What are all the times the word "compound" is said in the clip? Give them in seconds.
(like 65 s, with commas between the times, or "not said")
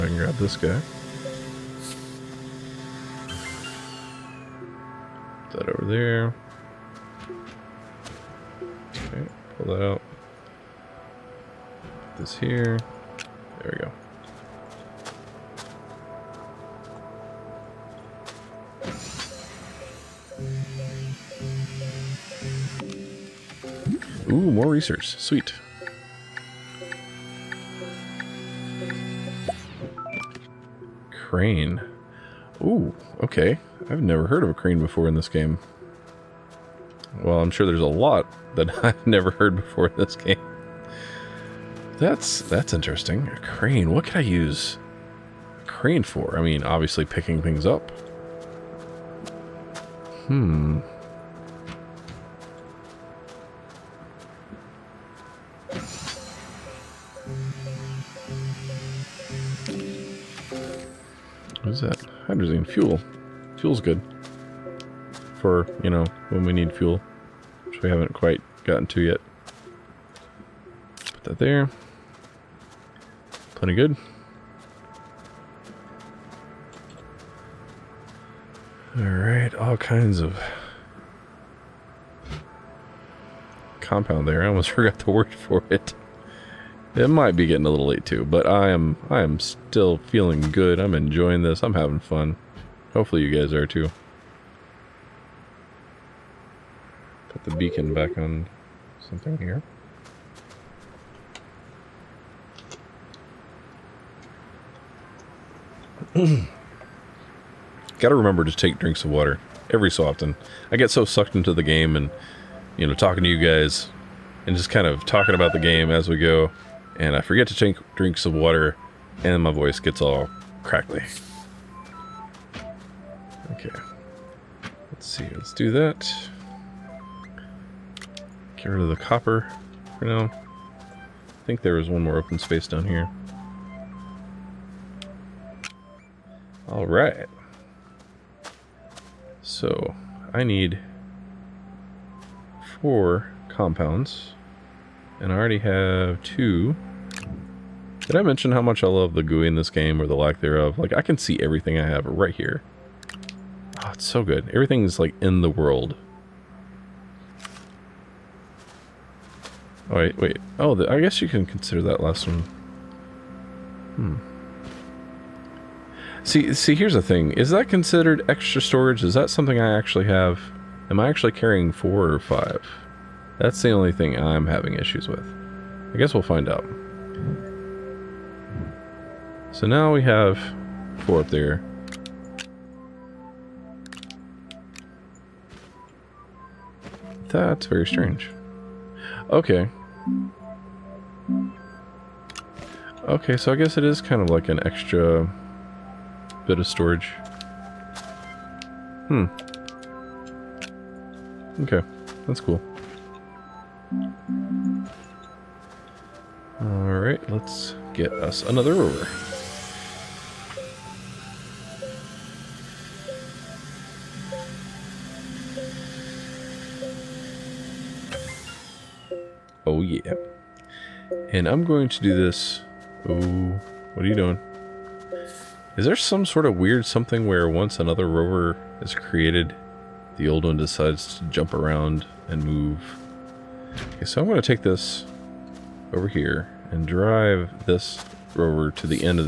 83 s, 143 s.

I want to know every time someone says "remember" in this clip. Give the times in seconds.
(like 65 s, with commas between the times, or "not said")
108 s.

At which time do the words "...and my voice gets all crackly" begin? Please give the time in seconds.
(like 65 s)
119 s.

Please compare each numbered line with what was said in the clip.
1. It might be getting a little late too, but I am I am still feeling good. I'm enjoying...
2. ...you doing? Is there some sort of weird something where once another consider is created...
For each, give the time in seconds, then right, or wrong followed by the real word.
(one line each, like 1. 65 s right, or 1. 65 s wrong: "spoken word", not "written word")
1. 86 s right
2. 224 s wrong: "rover", not "consider".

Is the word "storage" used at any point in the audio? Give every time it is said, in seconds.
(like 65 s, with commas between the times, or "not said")
168 s, 196 s.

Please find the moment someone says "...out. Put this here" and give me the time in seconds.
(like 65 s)
9 s.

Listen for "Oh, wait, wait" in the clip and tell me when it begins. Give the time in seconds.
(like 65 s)
159 s.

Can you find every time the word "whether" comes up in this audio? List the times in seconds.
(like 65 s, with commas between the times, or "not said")
not said.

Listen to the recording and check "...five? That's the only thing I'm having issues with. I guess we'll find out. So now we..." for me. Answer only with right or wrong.
right.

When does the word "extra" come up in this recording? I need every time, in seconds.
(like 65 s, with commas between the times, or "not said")
168 s, 194 s.